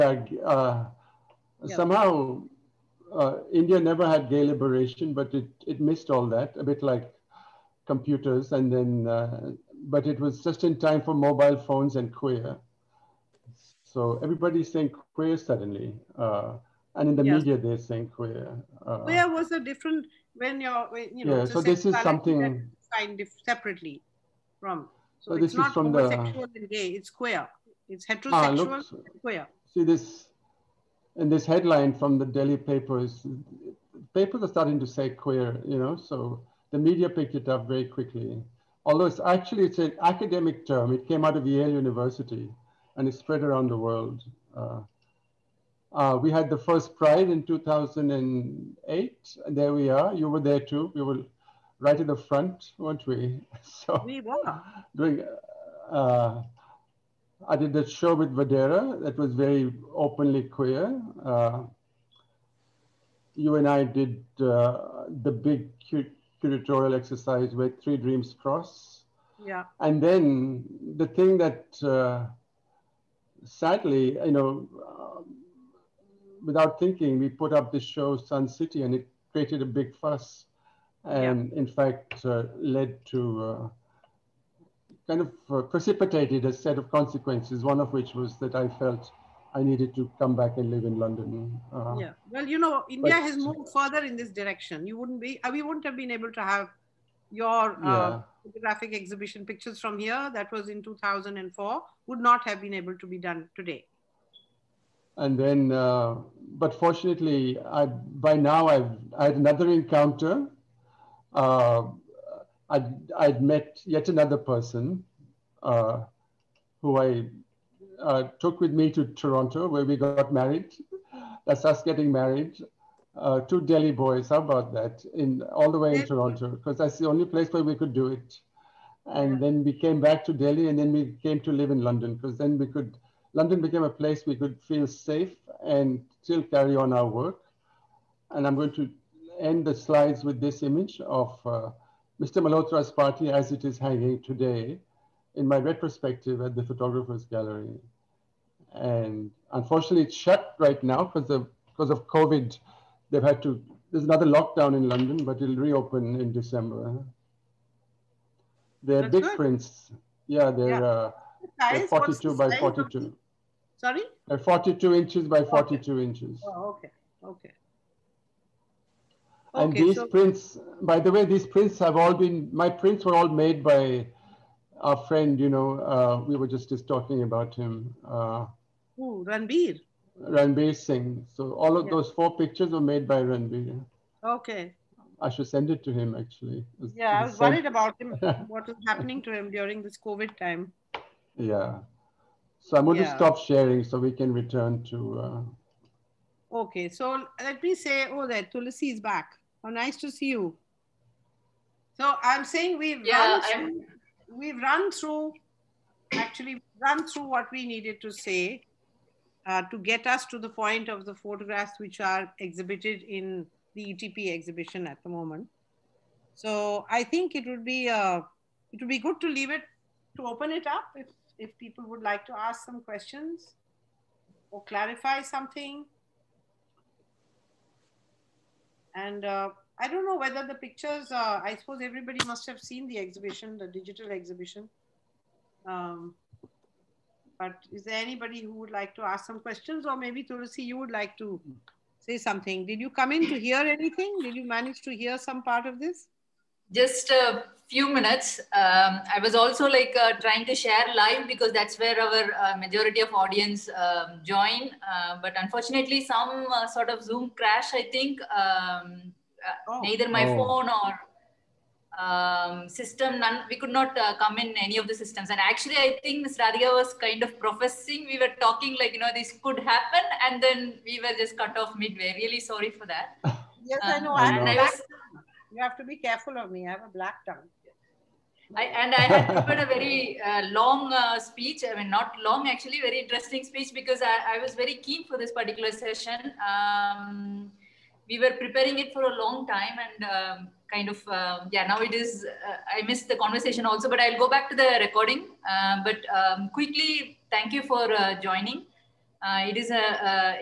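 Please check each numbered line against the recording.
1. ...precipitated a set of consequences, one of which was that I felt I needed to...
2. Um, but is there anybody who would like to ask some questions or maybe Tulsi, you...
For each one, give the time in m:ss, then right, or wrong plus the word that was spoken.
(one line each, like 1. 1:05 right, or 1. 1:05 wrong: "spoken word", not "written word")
1. 1:25 right
2. 3:55 right.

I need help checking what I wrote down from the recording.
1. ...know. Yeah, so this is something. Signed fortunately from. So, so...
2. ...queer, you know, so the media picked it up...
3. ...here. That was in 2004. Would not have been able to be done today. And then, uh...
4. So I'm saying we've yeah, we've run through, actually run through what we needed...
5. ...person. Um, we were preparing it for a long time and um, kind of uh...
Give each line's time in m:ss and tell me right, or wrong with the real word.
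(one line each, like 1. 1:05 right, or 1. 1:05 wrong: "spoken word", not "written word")
1. 0:21 wrong: "separately", not "fortunately"
2. 0:35 right
3. 1:39 right
4. 3:21 right
5. 4:45 wrong: "session", not "person".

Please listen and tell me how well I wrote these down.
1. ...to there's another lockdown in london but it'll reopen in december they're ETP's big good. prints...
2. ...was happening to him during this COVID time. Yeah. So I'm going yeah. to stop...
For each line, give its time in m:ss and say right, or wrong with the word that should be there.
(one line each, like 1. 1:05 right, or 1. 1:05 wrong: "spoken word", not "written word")
1. 2:33 wrong: "That", not "ETP"
2. 3:08 right.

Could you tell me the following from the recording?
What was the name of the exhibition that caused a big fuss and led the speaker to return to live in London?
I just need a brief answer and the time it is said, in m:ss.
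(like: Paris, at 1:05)
Sun City, at 1:18.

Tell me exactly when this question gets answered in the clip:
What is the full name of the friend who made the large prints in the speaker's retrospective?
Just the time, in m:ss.
3:00.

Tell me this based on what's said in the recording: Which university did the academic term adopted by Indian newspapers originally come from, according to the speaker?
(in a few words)
Yale University.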